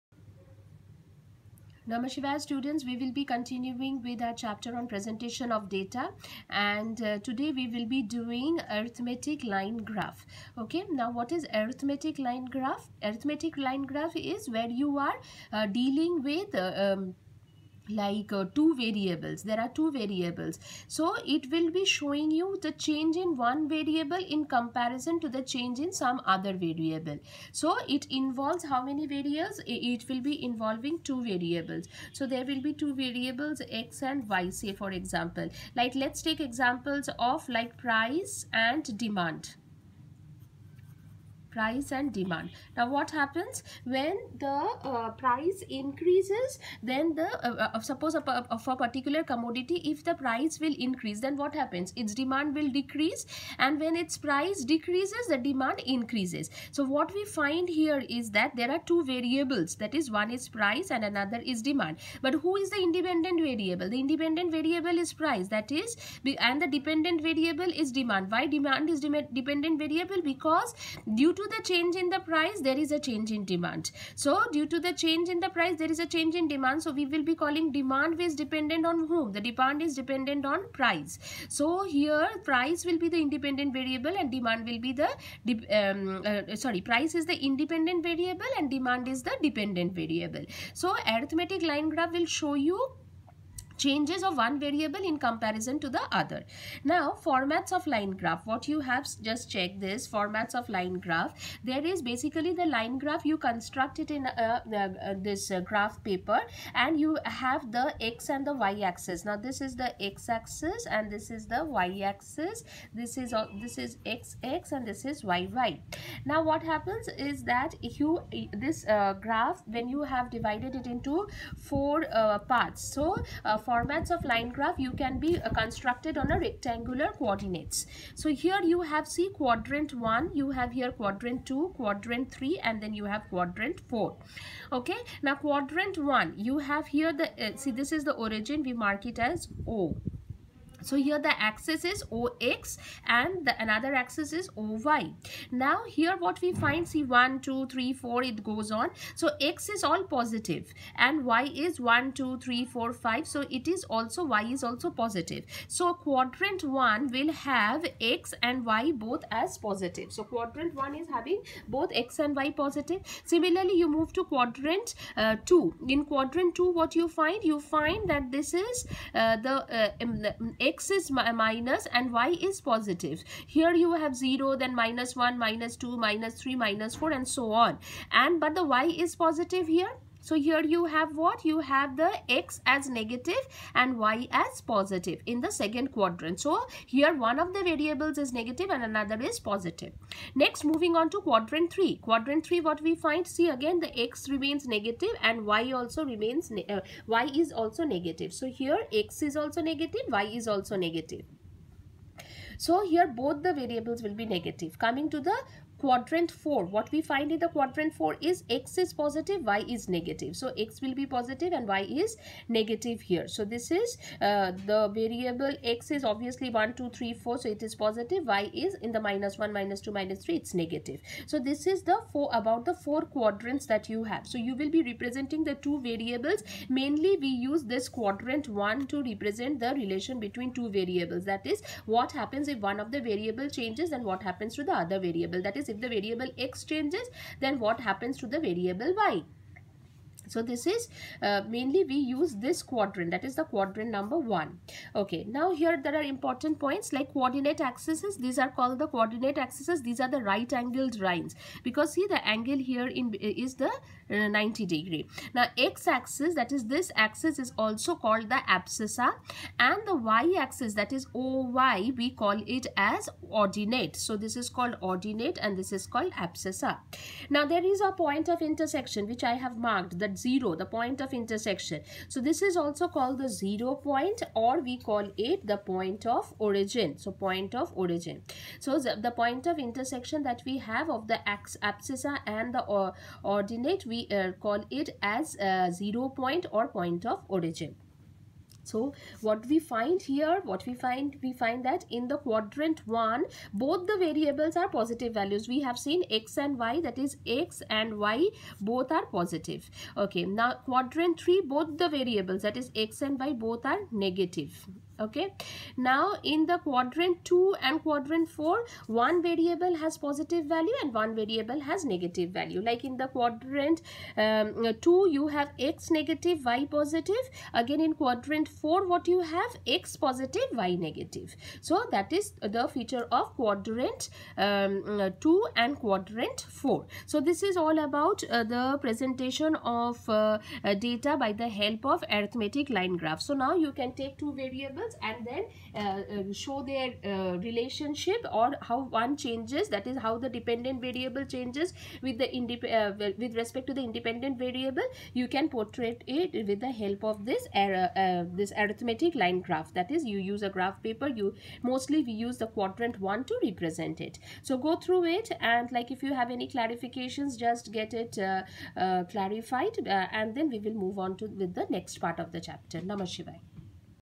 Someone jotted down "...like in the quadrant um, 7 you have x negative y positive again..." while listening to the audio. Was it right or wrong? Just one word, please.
wrong.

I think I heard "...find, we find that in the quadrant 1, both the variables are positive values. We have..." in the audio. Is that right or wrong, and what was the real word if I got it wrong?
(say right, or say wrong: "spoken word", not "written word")
right.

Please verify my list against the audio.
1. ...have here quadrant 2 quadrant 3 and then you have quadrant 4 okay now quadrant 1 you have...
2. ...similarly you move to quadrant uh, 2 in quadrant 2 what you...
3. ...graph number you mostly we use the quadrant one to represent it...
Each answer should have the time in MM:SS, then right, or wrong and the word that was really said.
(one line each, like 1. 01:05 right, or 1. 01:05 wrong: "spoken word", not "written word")
1. 02:10 right
2. 02:43 right
3. 05:50 wrong: "paper", not "number".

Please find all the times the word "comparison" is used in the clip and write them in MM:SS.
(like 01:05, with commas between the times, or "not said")
00:24, 01:35.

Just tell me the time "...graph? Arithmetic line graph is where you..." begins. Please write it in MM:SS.
00:12.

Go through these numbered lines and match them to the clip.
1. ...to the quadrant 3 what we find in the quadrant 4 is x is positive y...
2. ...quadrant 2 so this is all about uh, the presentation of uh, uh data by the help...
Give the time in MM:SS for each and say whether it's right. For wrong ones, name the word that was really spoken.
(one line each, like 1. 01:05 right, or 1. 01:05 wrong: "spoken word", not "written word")
1. 03:25 wrong: "4", not "3"
2. 05:25 wrong: "4", not "2".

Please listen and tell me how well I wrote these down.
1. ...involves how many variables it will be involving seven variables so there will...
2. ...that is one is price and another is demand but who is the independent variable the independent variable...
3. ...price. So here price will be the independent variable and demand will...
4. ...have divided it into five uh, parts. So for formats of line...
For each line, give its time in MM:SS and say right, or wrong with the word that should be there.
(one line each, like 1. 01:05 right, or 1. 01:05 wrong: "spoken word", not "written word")
1. 00:28 wrong: "two", not "seven"
2. 00:59 right
3. 01:20 right
4. 02:00 wrong: "four", not "five".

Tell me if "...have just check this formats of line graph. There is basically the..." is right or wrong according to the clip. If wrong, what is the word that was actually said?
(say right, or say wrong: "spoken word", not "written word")
right.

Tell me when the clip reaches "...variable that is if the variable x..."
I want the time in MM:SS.
03:55.